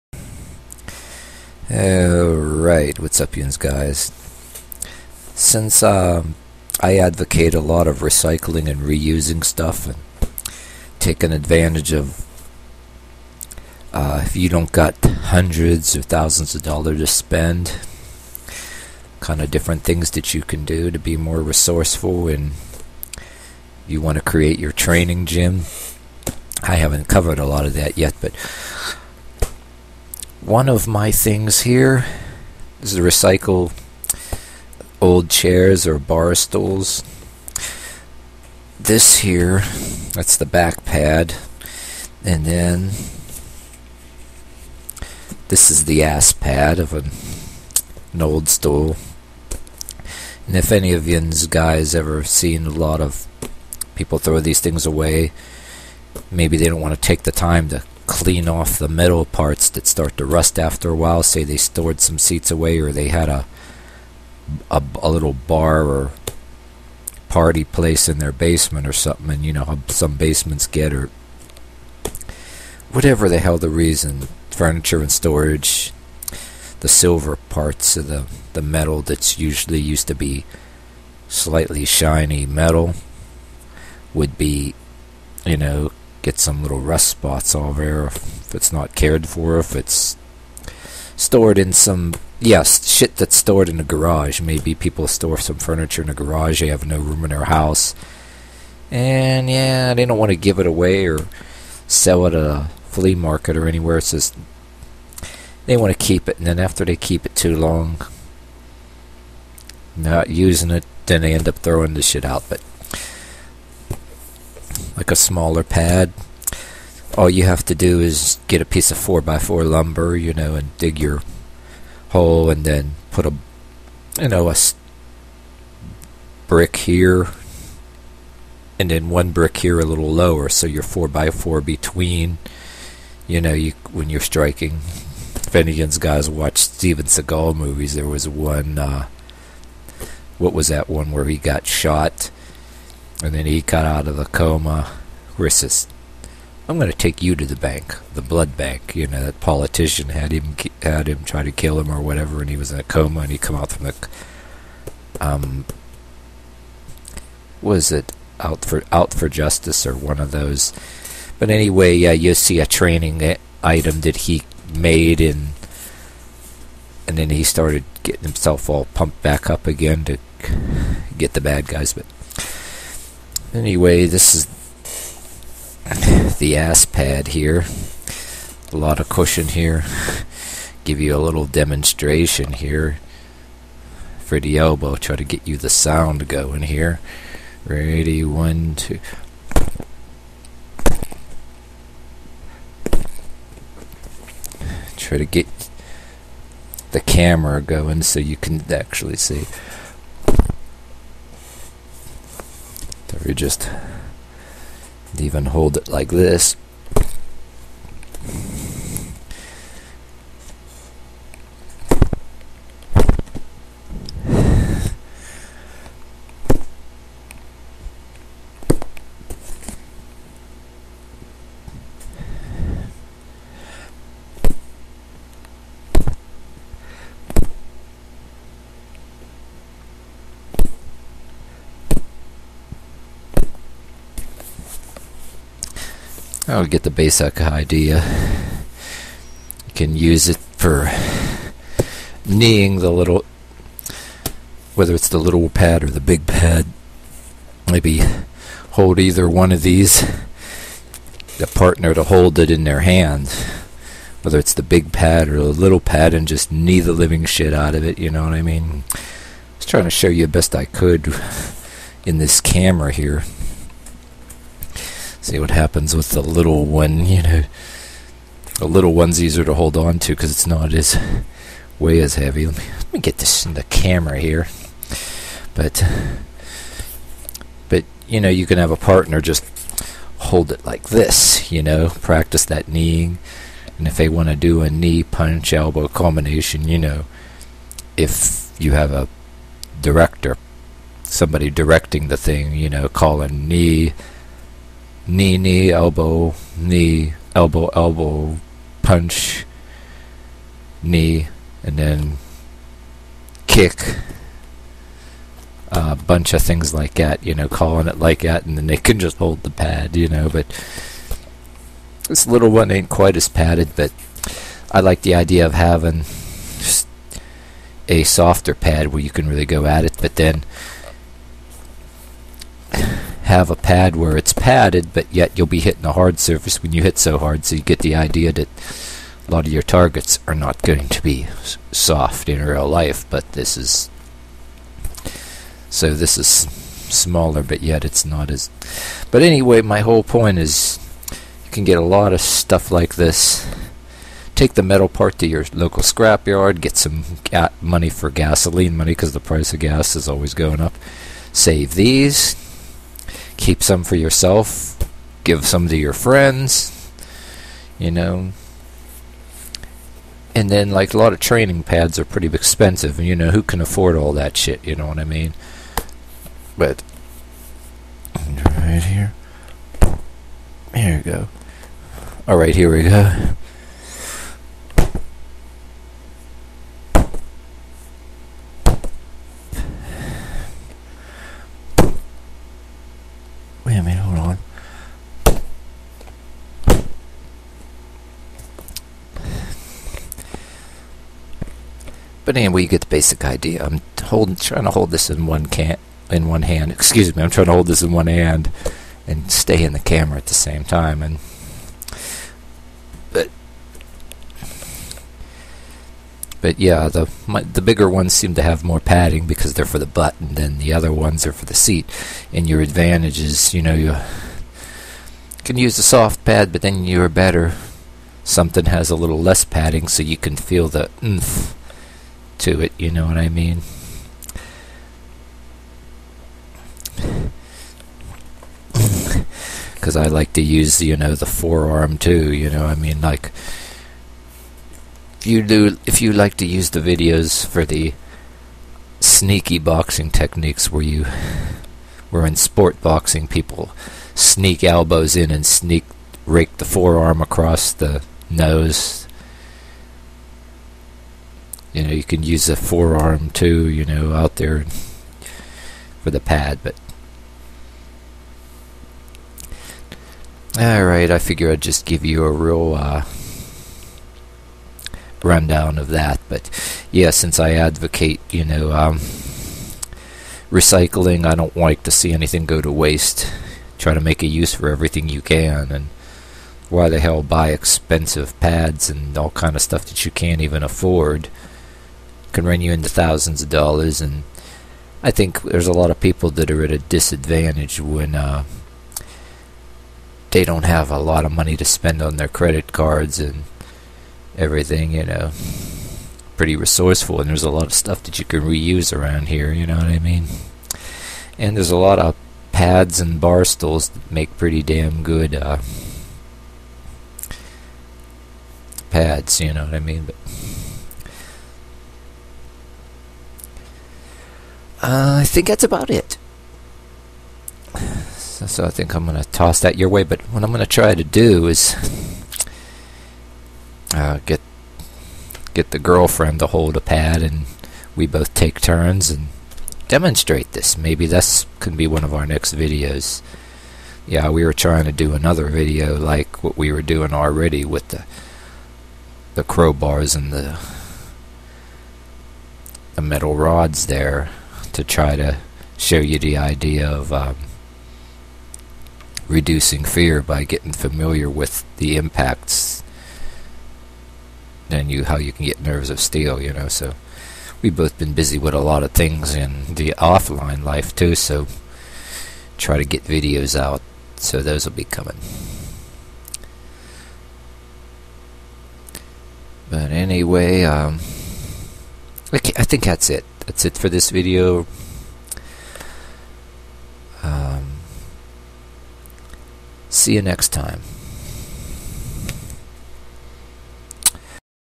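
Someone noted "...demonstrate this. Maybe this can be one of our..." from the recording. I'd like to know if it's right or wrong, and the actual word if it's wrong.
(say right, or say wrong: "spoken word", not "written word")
right.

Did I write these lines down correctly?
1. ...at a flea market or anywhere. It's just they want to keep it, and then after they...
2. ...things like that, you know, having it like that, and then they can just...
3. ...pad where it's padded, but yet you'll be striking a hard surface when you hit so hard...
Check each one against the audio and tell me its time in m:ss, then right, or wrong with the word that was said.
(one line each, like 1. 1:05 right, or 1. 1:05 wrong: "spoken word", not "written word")
1. 1:42 right
2. 5:06 wrong: "calling", not "having"
3. 5:23 wrong: "hitting", not "striking".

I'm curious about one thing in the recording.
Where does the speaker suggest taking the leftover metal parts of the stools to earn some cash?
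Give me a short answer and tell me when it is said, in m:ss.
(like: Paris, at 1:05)
Local scrapyard, at 5:45.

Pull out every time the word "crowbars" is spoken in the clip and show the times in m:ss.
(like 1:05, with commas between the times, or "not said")
8:59.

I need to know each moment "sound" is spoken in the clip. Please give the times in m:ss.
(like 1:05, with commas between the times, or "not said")
3:05.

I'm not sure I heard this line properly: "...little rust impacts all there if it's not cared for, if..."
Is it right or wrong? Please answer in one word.
wrong.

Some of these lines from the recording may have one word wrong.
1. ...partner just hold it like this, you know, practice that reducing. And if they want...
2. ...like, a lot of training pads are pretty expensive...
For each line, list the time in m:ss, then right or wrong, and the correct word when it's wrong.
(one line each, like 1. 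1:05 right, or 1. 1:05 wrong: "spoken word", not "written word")
1. 4:38 wrong: "kneeing", not "reducing"
2. 6:00 right.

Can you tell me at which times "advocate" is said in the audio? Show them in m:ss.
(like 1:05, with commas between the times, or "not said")
0:06, 7:47.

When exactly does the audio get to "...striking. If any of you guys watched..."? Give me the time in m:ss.
2:14.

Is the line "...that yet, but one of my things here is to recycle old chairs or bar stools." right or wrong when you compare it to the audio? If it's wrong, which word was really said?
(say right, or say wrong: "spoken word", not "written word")
right.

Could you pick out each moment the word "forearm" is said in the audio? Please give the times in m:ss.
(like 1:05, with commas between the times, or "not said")
7:11, 7:26, 7:32.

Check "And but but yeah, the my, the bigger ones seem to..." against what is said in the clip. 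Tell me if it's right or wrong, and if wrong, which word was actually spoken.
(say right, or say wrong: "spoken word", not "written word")
right.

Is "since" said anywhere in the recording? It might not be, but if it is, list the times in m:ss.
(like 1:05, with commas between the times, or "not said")
0:05, 7:47.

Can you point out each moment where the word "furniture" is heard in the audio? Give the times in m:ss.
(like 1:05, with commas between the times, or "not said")
1:14, 1:35.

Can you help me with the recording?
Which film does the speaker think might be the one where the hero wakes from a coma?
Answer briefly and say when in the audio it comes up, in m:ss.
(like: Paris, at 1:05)
Out for Justice, at 2:38.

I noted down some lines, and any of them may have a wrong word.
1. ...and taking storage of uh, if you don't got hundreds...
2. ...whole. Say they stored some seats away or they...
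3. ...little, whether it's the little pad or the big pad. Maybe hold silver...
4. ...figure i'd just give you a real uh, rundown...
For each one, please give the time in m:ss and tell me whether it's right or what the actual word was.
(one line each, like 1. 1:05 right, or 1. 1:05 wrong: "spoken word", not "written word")
1. 0:09 wrong: "advantage", not "storage"
2. 1:00 wrong: "while", not "whole"
3. 4:02 wrong: "either", not "silver"
4. 7:41 right.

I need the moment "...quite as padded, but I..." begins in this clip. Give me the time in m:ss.
5:12.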